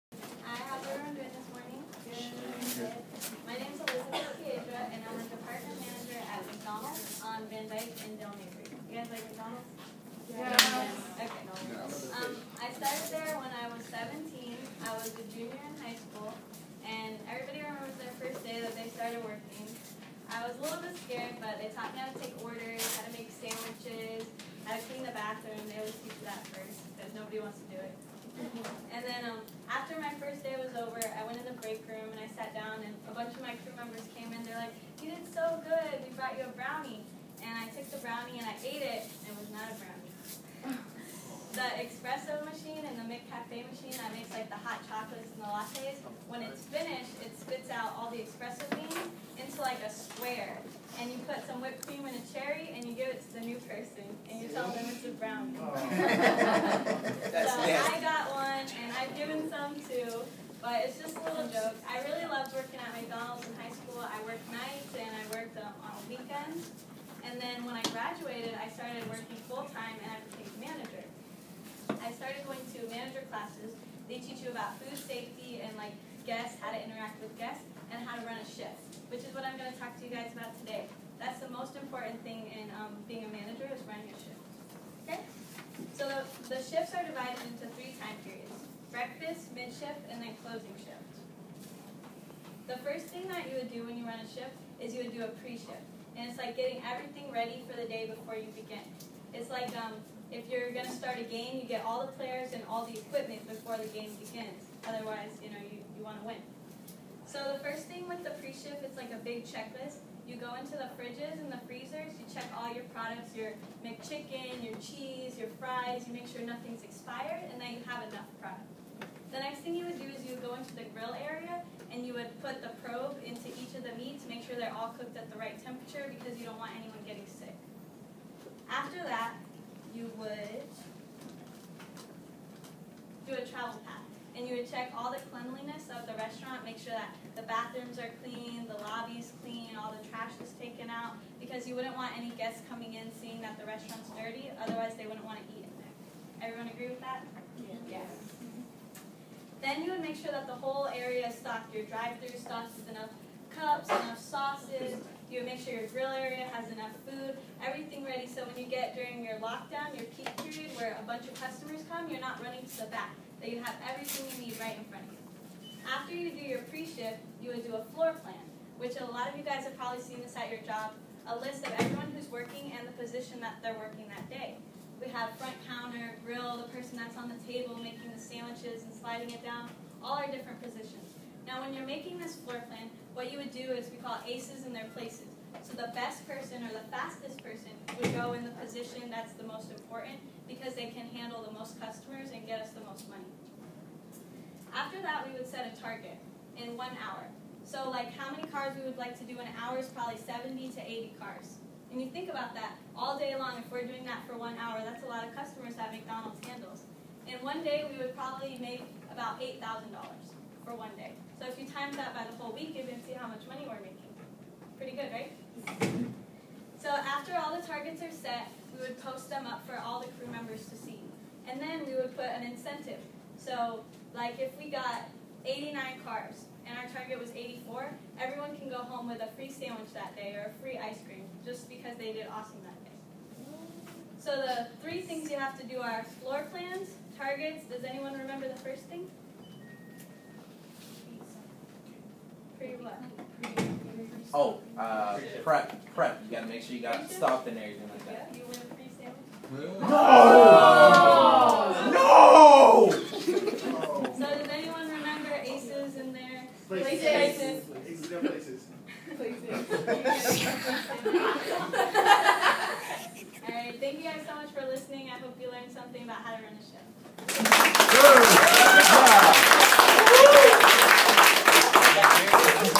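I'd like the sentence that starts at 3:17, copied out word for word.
So like how many cars we would like to do in an hour is probably 70 to 80 cars.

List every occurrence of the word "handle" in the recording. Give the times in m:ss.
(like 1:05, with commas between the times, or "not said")
3:11, 3:26.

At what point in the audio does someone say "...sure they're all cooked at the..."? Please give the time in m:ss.
2:04.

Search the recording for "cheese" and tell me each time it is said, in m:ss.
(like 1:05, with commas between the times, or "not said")
1:54.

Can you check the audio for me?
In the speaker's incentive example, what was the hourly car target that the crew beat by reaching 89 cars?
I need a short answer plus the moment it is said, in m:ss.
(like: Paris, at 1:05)
84, at 3:47.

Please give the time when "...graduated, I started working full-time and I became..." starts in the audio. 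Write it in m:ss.
1:07.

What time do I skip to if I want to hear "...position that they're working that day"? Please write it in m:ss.
2:52.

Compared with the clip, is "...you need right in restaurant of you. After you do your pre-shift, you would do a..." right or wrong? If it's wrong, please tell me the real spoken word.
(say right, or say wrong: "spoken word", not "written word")
wrong: "front", not "restaurant".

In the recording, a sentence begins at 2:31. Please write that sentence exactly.
Your drive-through stocked with enough cups, enough sauces.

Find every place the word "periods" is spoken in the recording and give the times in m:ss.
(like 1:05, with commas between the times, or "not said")
1:28, 2:40.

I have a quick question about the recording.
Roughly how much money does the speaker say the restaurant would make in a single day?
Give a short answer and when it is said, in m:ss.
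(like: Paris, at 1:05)
$8,000, at 3:29.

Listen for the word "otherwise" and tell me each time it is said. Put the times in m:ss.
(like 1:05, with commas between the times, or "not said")
1:44, 2:24.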